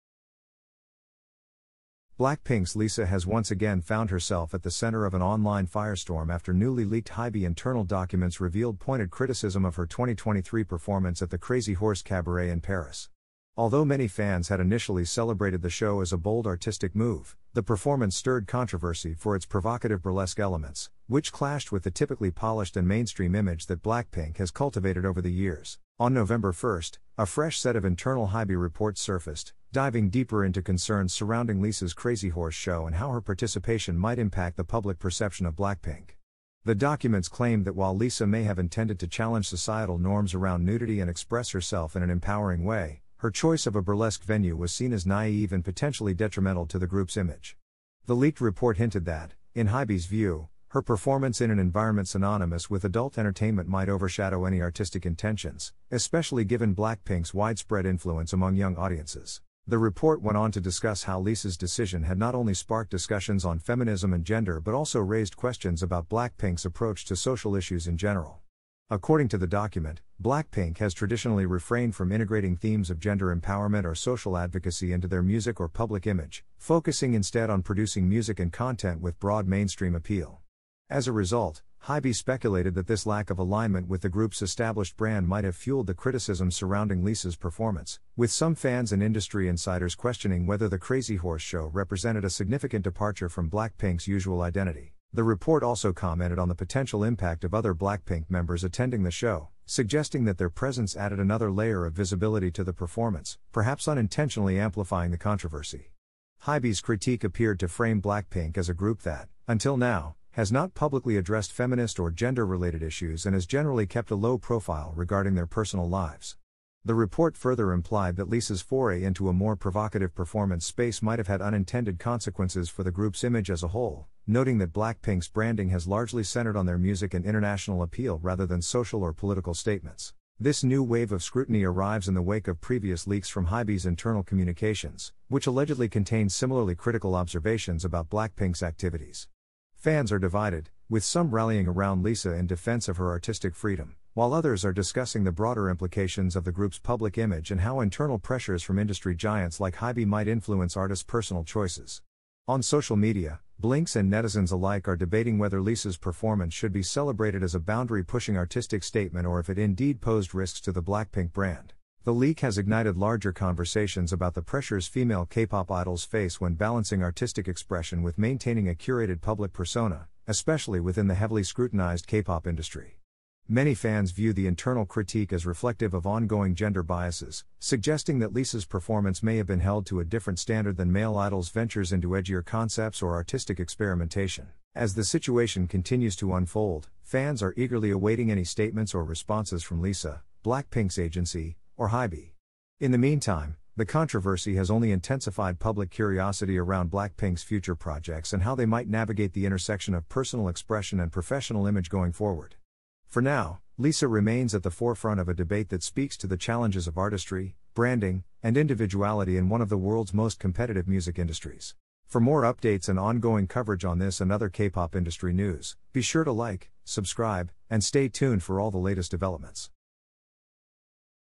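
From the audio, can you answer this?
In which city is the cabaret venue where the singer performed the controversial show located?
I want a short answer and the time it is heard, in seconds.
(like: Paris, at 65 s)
Paris, at 12 s.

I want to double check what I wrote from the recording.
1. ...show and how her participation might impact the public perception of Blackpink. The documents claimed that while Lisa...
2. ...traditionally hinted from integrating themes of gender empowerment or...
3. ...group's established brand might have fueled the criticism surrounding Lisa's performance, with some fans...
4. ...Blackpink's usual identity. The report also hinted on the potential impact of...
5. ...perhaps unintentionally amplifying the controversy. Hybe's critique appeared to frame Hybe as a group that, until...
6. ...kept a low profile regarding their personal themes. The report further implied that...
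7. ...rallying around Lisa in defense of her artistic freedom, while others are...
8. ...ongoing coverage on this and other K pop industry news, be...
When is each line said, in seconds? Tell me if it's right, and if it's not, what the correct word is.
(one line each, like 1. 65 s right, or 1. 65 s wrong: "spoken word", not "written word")
1. 32 s right
2. 70 s wrong: "refrained", not "hinted"
3. 84 s right
4. 93 s wrong: "commented", not "hinted"
5. 103 s wrong: "Blackpink", not "Hybe"
6. 113 s wrong: "lives", not "themes"
7. 141 s right
8. 212 s right.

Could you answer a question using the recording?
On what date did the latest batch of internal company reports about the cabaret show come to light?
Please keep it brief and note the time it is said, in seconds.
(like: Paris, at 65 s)
November 1, at 26 s.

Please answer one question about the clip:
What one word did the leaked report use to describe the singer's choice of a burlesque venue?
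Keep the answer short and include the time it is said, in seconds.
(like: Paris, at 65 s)
naive, at 45 s.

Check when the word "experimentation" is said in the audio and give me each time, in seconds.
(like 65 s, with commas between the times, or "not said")
183 s.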